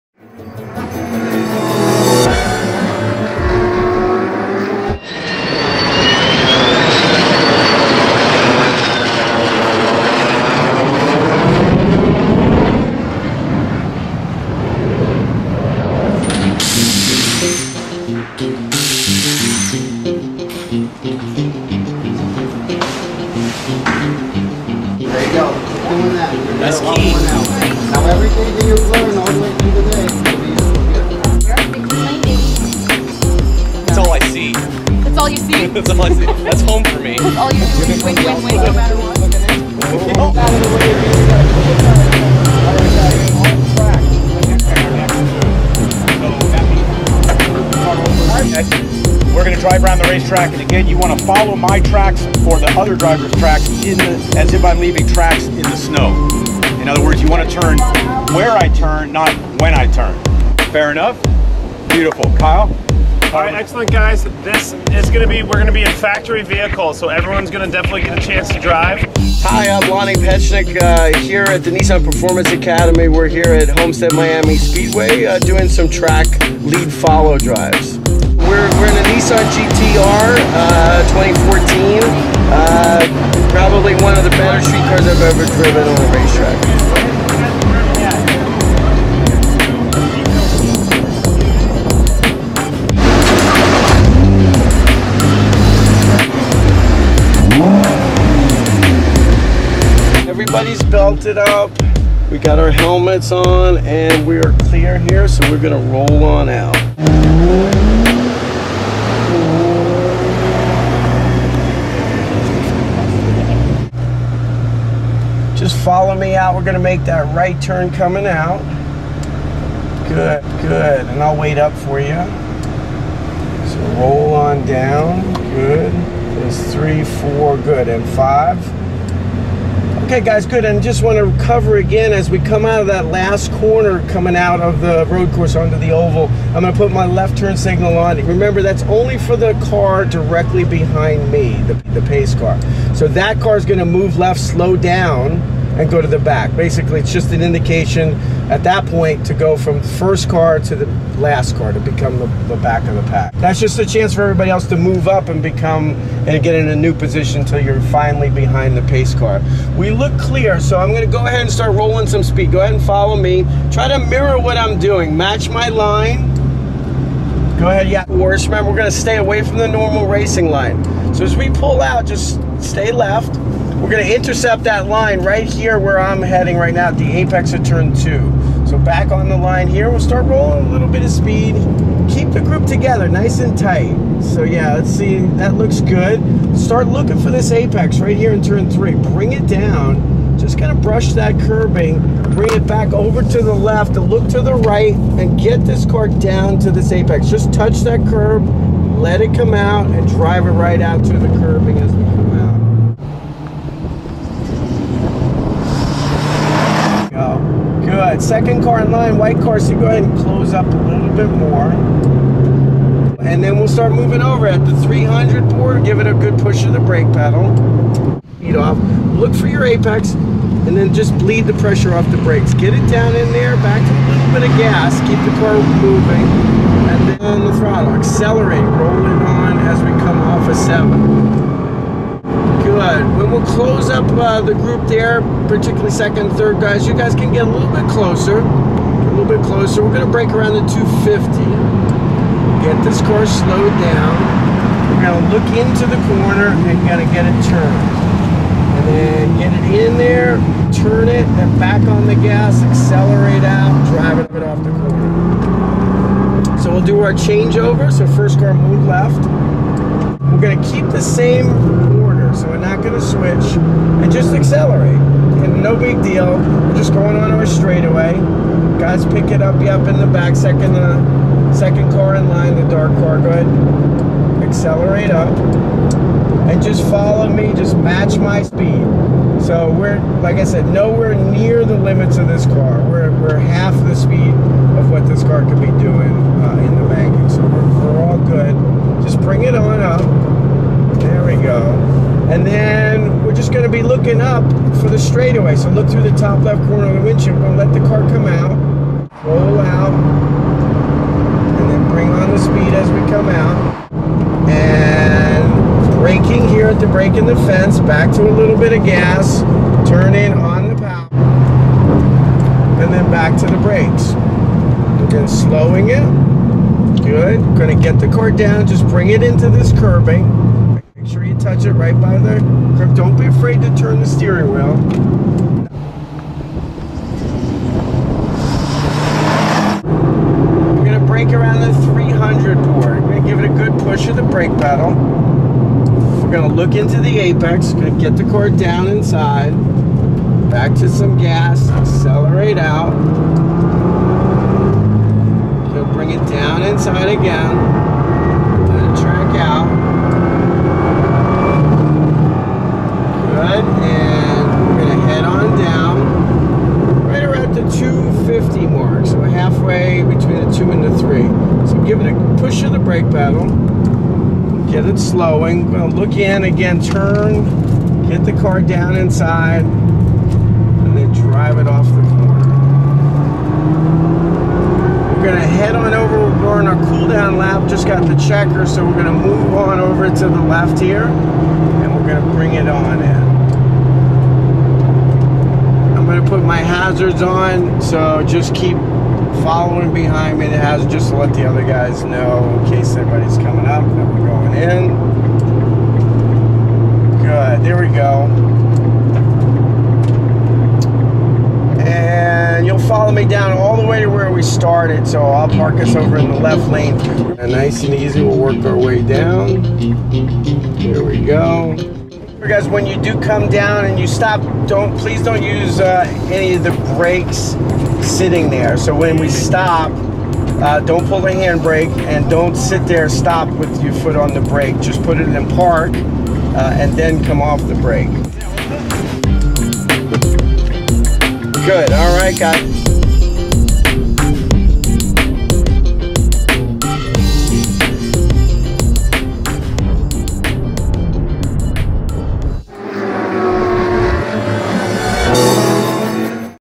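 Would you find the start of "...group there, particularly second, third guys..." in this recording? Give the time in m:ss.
3:54.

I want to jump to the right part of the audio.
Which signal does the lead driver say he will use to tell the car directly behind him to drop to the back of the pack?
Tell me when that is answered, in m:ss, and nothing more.
2:17.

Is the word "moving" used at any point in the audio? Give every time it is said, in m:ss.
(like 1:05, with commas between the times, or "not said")
3:33, 3:45.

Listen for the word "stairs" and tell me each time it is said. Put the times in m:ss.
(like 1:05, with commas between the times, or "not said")
not said.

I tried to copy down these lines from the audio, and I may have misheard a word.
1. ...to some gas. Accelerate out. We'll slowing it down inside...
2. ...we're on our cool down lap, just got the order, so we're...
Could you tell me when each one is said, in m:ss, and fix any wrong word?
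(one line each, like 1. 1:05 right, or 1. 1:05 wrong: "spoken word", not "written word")
1. 5:40 wrong: "bring", not "slowing"
2. 6:16 wrong: "checker", not "order".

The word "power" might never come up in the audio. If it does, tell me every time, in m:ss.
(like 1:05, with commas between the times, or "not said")
5:10.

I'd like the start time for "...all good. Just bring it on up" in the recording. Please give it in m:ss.
4:48.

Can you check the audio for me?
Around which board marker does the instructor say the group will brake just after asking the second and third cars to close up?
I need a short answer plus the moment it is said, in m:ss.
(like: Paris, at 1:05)
250, at 4:00.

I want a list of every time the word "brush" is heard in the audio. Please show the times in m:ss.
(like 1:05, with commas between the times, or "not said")
3:10.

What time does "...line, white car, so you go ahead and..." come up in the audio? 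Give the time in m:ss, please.
3:28.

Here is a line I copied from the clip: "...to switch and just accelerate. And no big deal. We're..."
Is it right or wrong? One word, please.
right.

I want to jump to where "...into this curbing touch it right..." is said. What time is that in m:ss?
5:19.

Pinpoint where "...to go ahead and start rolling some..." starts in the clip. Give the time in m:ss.
2:41.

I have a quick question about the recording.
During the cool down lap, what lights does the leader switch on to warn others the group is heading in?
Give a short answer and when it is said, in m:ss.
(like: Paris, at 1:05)
Hazards, at 6:26.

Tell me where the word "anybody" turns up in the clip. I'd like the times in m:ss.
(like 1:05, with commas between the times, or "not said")
6:32.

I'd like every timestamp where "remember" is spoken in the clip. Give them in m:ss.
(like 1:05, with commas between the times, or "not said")
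2:18, 2:48.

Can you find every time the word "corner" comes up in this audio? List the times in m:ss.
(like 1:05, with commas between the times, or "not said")
2:13, 4:06, 4:14, 4:56, 6:12.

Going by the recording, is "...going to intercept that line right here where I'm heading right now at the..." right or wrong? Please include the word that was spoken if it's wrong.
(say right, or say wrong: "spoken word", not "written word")
right.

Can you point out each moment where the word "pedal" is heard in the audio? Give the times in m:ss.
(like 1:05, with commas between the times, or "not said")
3:37, 5:34.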